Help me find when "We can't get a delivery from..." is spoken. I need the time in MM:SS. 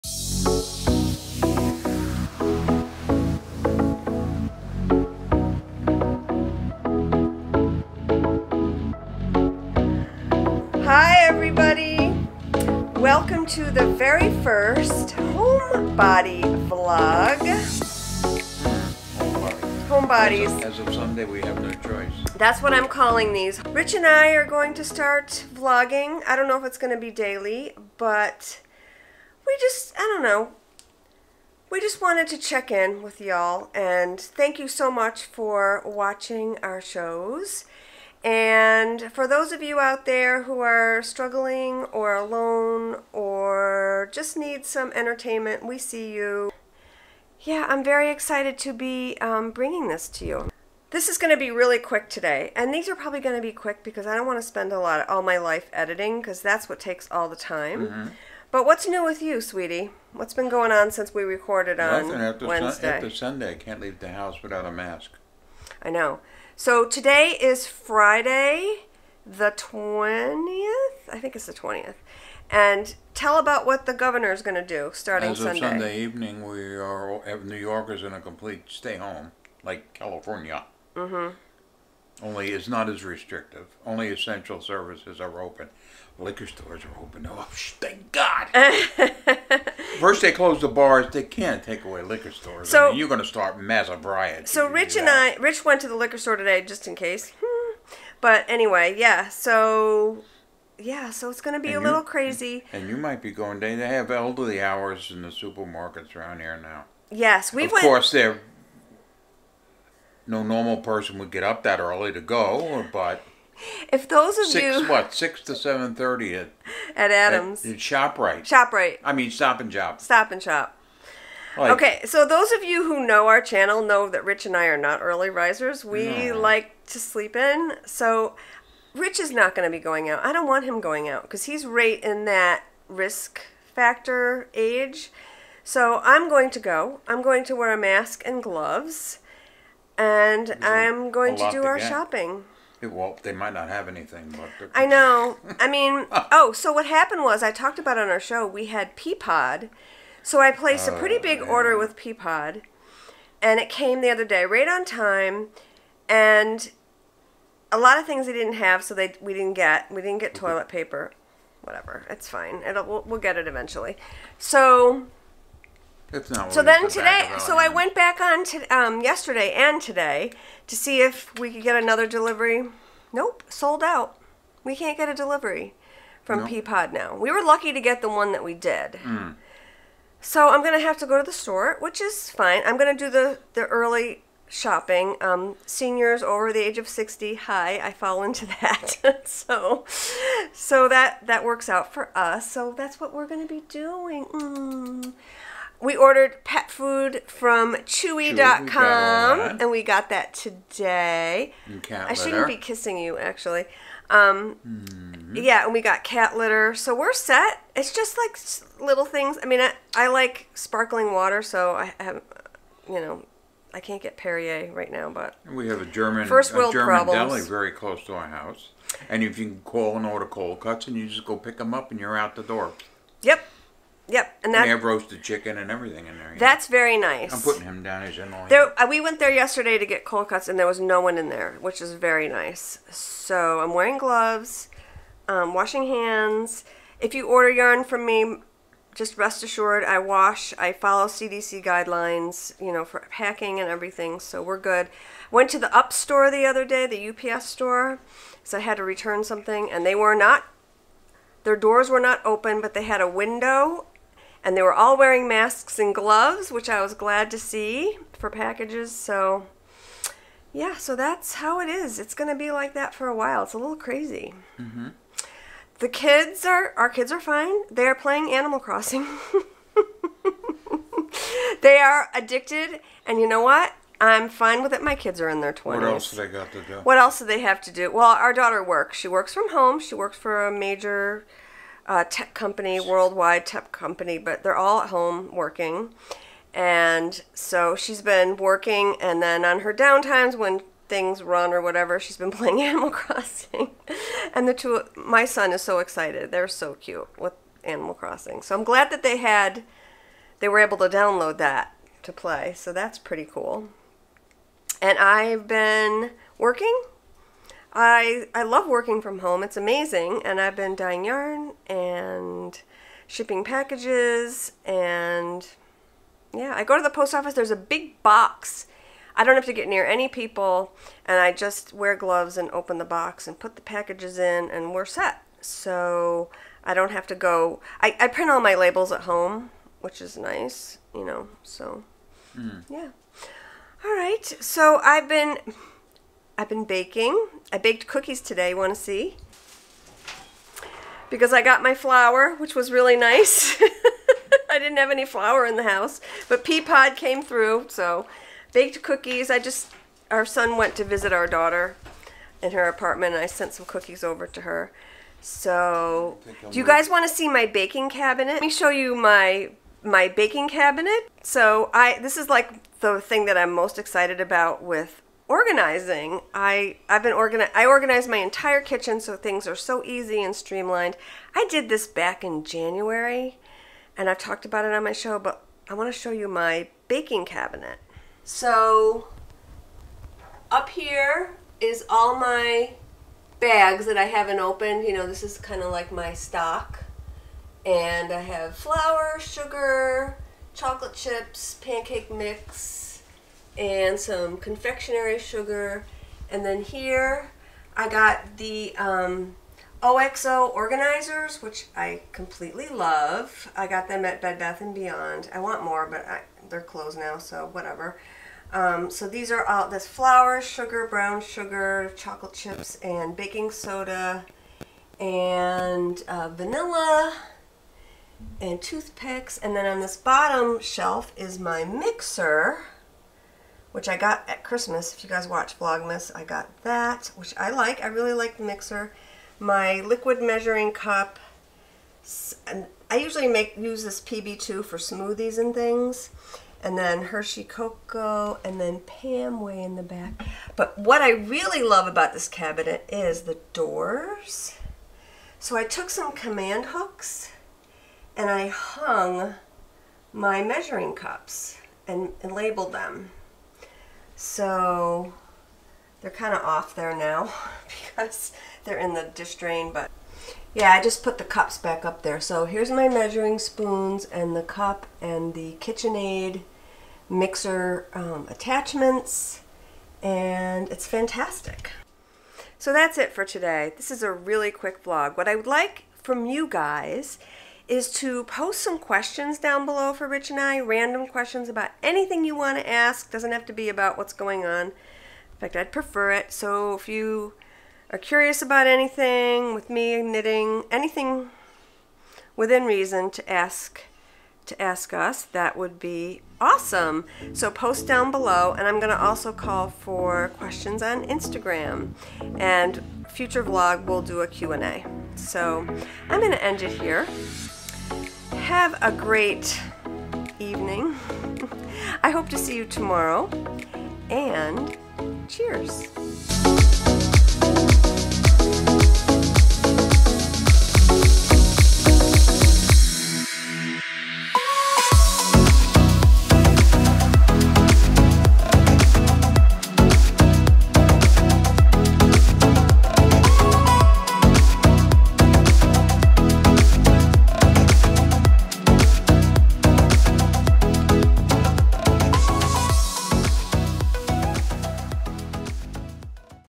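02:54.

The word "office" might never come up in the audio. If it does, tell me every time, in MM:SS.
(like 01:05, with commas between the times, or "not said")
05:17.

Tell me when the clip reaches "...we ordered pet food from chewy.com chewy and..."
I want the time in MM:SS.
03:15.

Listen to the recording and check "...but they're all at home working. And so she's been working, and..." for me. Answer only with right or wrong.
right.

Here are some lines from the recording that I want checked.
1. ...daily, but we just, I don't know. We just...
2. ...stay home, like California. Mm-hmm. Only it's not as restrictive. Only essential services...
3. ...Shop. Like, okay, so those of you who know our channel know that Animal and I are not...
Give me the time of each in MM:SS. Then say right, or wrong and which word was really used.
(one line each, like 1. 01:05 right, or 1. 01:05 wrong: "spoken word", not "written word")
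1. 00:27 right
2. 01:18 right
3. 02:00 wrong: "Rich", not "Animal".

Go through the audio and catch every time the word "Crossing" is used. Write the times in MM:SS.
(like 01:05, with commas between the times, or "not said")
04:28, 04:52, 04:57.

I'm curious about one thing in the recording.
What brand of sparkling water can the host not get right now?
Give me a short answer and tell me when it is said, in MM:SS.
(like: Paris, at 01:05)
Perrier, at 03:34.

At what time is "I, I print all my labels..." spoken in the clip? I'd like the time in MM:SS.
05:27.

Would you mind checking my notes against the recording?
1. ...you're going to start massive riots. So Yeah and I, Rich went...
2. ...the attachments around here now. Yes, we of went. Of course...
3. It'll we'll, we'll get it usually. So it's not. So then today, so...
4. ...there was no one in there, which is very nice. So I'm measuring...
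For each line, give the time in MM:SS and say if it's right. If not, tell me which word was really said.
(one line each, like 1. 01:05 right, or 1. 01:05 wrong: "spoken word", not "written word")
1. 01:32 wrong: "Rich", not "Yeah"
2. 01:45 wrong: "supermarkets", not "attachments"
3. 02:42 wrong: "eventually", not "usually"
4. 03:50 wrong: "wearing", not "measuring".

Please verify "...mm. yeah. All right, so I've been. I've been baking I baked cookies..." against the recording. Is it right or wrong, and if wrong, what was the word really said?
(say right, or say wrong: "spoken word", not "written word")
right.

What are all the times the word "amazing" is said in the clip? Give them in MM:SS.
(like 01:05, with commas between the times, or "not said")
05:09.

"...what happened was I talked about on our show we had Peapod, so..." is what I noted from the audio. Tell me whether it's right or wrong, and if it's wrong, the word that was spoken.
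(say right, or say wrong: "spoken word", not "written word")
right.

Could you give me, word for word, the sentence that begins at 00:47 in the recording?
Yeah, I'm very excited to be um, bringing this to you.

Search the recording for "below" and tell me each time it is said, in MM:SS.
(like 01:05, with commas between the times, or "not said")
07:59, 08:18.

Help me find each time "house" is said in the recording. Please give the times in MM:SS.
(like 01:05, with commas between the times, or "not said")
01:04, 03:38, 05:45.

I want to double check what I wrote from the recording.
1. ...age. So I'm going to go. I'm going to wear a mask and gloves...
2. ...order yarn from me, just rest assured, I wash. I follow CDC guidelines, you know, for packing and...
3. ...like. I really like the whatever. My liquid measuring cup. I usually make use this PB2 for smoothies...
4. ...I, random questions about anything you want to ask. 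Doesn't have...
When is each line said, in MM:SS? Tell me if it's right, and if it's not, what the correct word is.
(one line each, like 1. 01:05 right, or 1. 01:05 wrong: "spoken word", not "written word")
1. 02:14 right
2. 03:57 right
3. 07:07 wrong: "mixer", not "whatever"
4. 08:00 right.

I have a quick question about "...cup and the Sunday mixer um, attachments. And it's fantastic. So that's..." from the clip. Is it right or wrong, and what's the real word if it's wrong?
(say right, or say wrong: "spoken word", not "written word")
wrong: "KitchenAid", not "Sunday".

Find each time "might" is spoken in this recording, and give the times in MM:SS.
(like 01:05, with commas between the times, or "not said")
01:42, 02:23.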